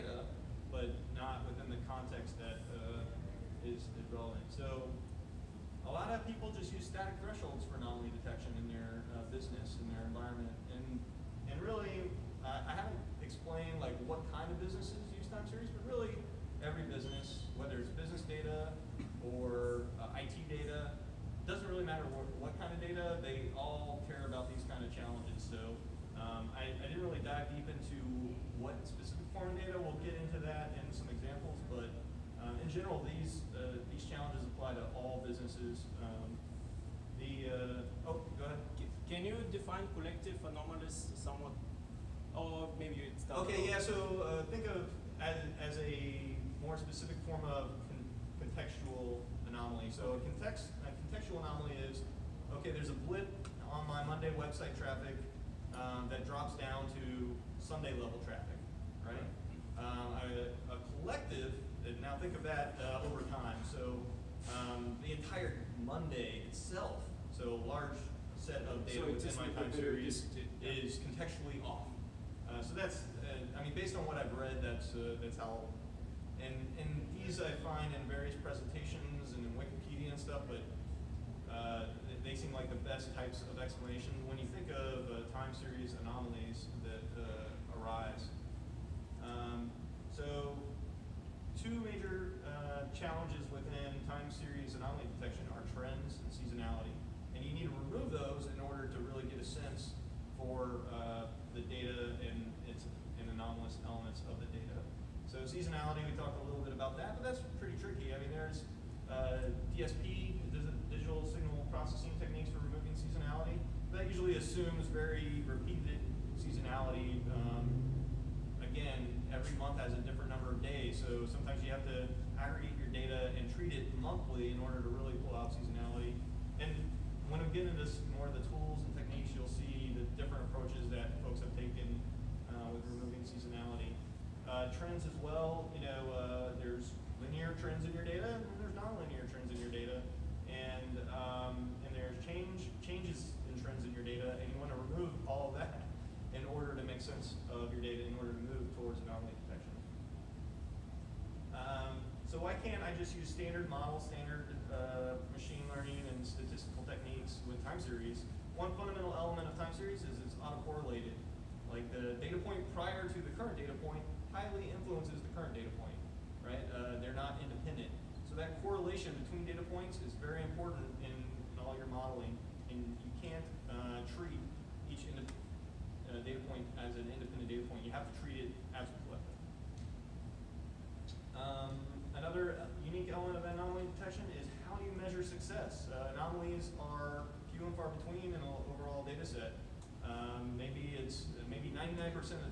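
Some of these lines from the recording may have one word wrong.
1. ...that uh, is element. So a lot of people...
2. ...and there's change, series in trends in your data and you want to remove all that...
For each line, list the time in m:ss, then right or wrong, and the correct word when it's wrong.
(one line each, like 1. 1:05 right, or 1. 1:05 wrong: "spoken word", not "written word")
1. 0:02 wrong: "relevant", not "element"
2. 2:21 wrong: "changes", not "series".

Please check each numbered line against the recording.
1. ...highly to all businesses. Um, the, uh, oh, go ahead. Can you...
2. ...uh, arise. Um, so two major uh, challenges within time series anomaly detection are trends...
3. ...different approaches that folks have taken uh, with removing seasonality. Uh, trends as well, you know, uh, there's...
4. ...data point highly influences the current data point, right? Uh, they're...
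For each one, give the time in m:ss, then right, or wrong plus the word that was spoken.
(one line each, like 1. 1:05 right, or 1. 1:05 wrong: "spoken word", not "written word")
1. 0:34 wrong: "apply", not "highly"
2. 1:27 right
3. 2:10 right
4. 2:43 right.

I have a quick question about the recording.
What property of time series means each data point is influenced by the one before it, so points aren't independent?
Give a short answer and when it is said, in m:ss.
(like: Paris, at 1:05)
Autocorrelated, at 2:40.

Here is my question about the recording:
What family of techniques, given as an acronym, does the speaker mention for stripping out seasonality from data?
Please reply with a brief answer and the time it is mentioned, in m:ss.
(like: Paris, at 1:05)
DSP (digital signal processing), at 1:49.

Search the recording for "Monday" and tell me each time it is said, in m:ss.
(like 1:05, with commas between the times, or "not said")
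0:54, 1:05.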